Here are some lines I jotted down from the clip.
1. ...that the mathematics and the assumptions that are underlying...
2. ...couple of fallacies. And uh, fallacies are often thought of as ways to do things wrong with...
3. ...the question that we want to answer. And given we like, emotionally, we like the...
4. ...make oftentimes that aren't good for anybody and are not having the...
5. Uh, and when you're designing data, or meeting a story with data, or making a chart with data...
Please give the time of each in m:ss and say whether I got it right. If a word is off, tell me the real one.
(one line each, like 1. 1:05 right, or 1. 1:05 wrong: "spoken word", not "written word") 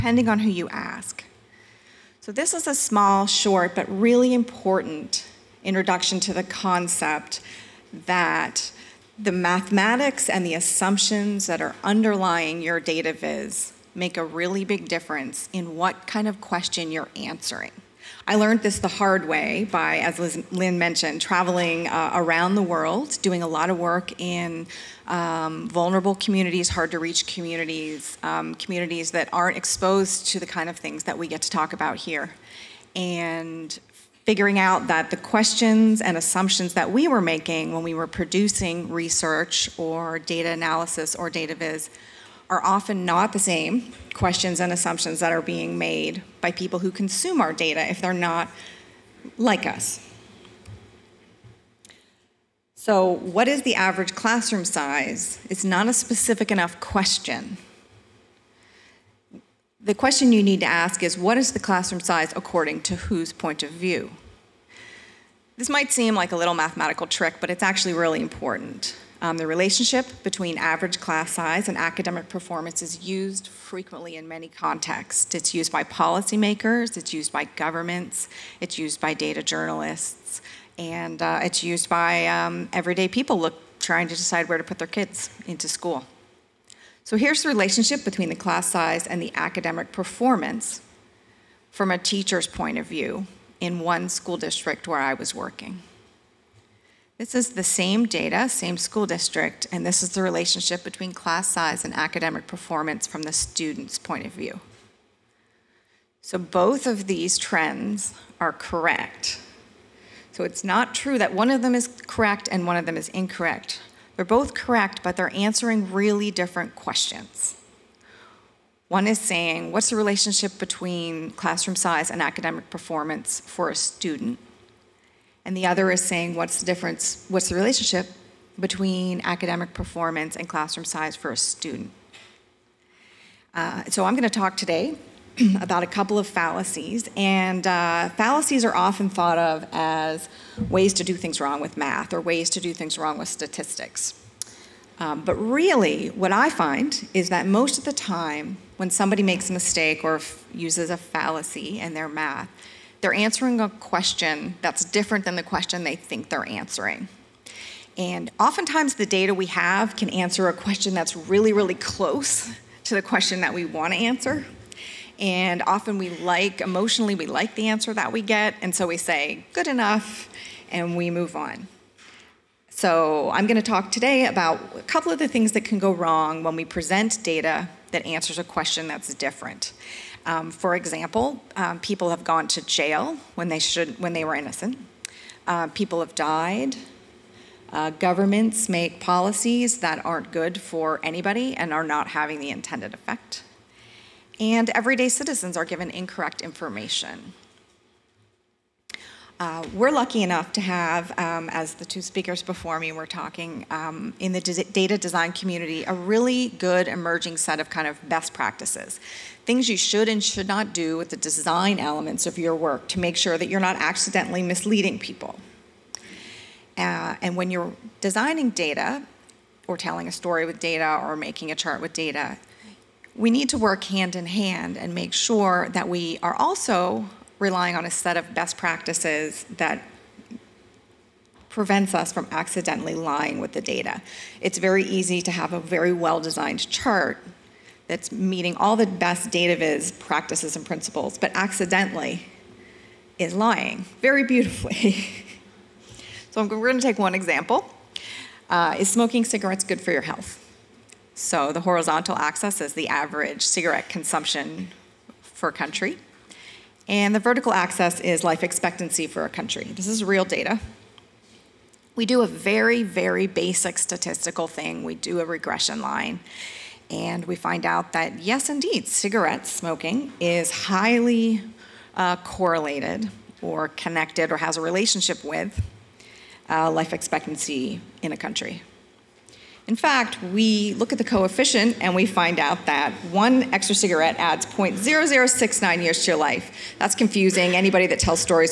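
1. 0:08 right
2. 2:15 right
3. 2:42 wrong: "often", not "given"
4. 3:08 wrong: "policies", not "oftentimes"
5. 3:36 wrong: "telling", not "meeting".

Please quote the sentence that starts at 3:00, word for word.
Um, for example, um, people have gone to jail when they should when they were innocent.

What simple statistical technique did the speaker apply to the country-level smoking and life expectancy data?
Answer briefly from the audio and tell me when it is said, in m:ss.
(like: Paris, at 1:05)
Regression line, at 4:25.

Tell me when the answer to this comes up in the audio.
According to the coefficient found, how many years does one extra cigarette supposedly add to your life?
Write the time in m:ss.
4:44.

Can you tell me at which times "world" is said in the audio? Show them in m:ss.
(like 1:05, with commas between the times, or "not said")
0:22.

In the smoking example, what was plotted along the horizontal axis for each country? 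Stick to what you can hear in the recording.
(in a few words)
Average cigarette consumption.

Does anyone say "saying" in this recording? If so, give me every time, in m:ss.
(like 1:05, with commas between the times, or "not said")
1:59, 2:06.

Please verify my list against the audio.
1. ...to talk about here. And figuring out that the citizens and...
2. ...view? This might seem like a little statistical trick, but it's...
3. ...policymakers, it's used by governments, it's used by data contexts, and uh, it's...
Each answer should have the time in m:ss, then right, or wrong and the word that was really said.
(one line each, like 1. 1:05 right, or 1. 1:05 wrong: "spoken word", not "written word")
1. 0:31 wrong: "questions", not "citizens"
2. 1:03 wrong: "mathematical", not "statistical"
3. 1:15 wrong: "journalists", not "contexts".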